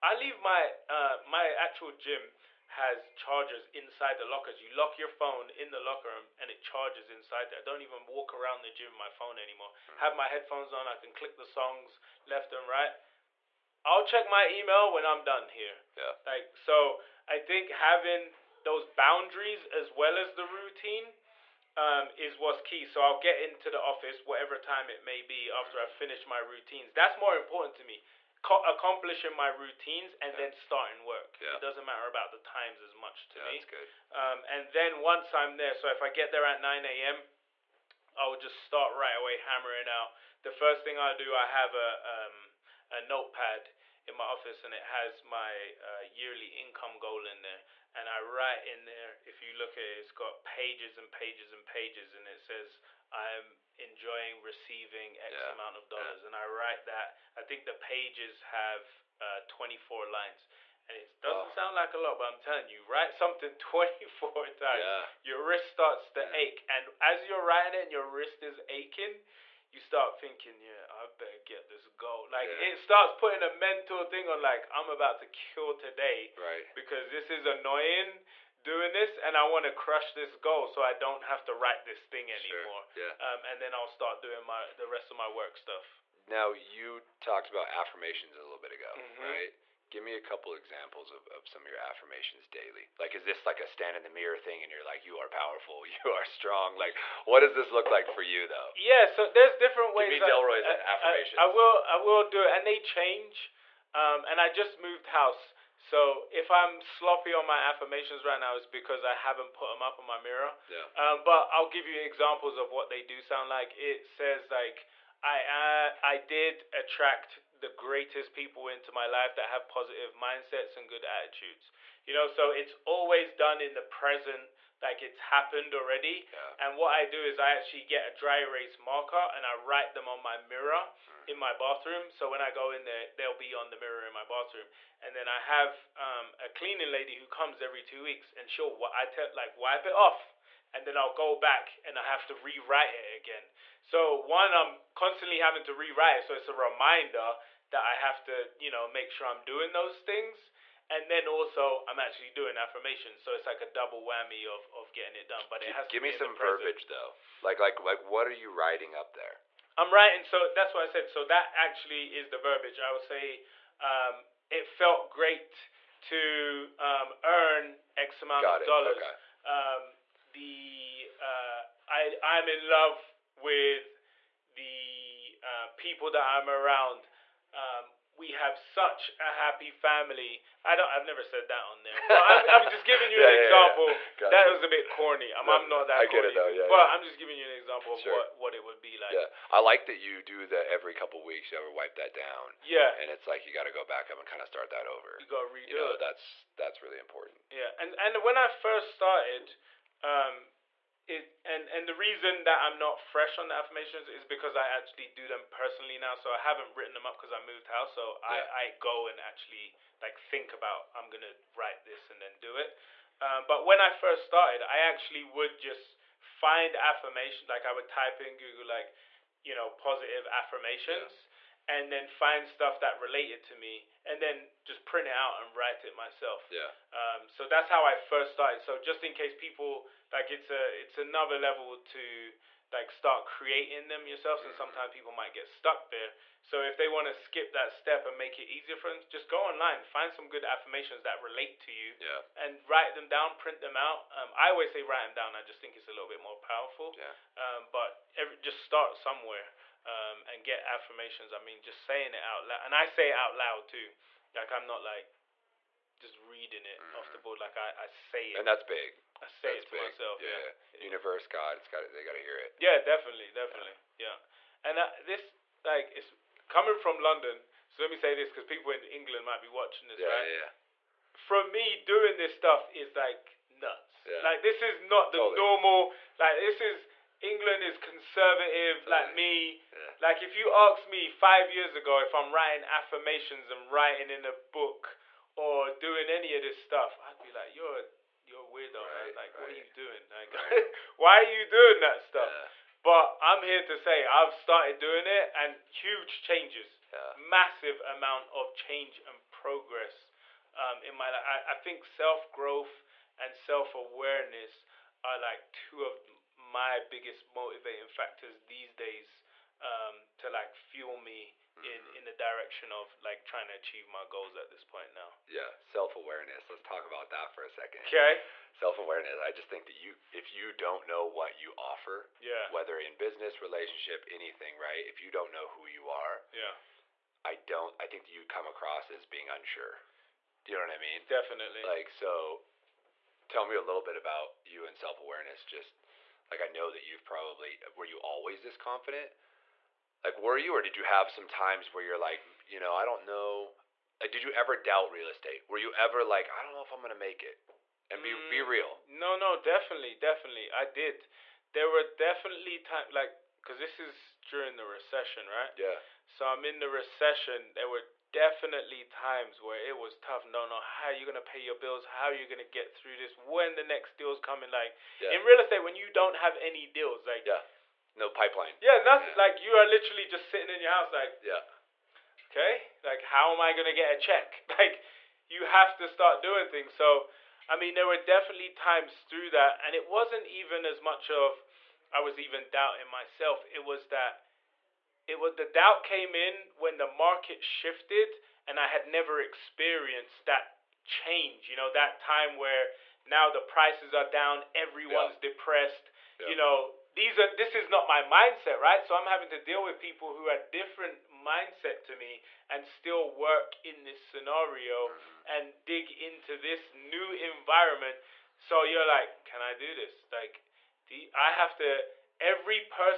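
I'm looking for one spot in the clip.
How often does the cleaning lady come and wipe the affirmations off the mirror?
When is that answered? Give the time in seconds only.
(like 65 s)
137 s.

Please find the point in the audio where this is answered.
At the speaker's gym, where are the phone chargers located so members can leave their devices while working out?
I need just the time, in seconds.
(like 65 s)
3 s.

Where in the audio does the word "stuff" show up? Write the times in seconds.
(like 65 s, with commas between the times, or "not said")
85 s, 222 s, 272 s, 286 s, 292 s.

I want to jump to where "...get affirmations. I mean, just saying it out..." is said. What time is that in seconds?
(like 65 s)
250 s.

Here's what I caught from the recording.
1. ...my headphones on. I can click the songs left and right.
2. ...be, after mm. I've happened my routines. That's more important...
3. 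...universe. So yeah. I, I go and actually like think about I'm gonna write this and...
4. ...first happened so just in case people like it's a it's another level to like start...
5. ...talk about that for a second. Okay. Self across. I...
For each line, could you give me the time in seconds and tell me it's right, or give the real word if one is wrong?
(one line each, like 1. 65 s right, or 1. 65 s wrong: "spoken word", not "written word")
1. 10 s right
2. 25 s wrong: "finished", not "happened"
3. 207 s wrong: "house", not "universe"
4. 227 s wrong: "started", not "happened"
5. 316 s wrong: "awareness", not "across".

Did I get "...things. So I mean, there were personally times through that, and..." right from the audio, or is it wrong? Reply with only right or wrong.
wrong.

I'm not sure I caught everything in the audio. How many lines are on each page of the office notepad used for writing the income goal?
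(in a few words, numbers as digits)
24.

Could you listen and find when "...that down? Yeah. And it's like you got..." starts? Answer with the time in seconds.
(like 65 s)
191 s.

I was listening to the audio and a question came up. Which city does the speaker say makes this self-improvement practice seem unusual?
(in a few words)
London.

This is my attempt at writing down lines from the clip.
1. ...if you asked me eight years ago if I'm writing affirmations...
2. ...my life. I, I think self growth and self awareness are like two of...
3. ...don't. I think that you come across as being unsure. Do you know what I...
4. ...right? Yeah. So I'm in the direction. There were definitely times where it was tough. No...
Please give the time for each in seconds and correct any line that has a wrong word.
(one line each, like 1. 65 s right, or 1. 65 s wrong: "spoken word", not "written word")
1. 280 s wrong: "five", not "eight"
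2. 300 s right
3. 327 s right
4. 355 s wrong: "recession", not "direction".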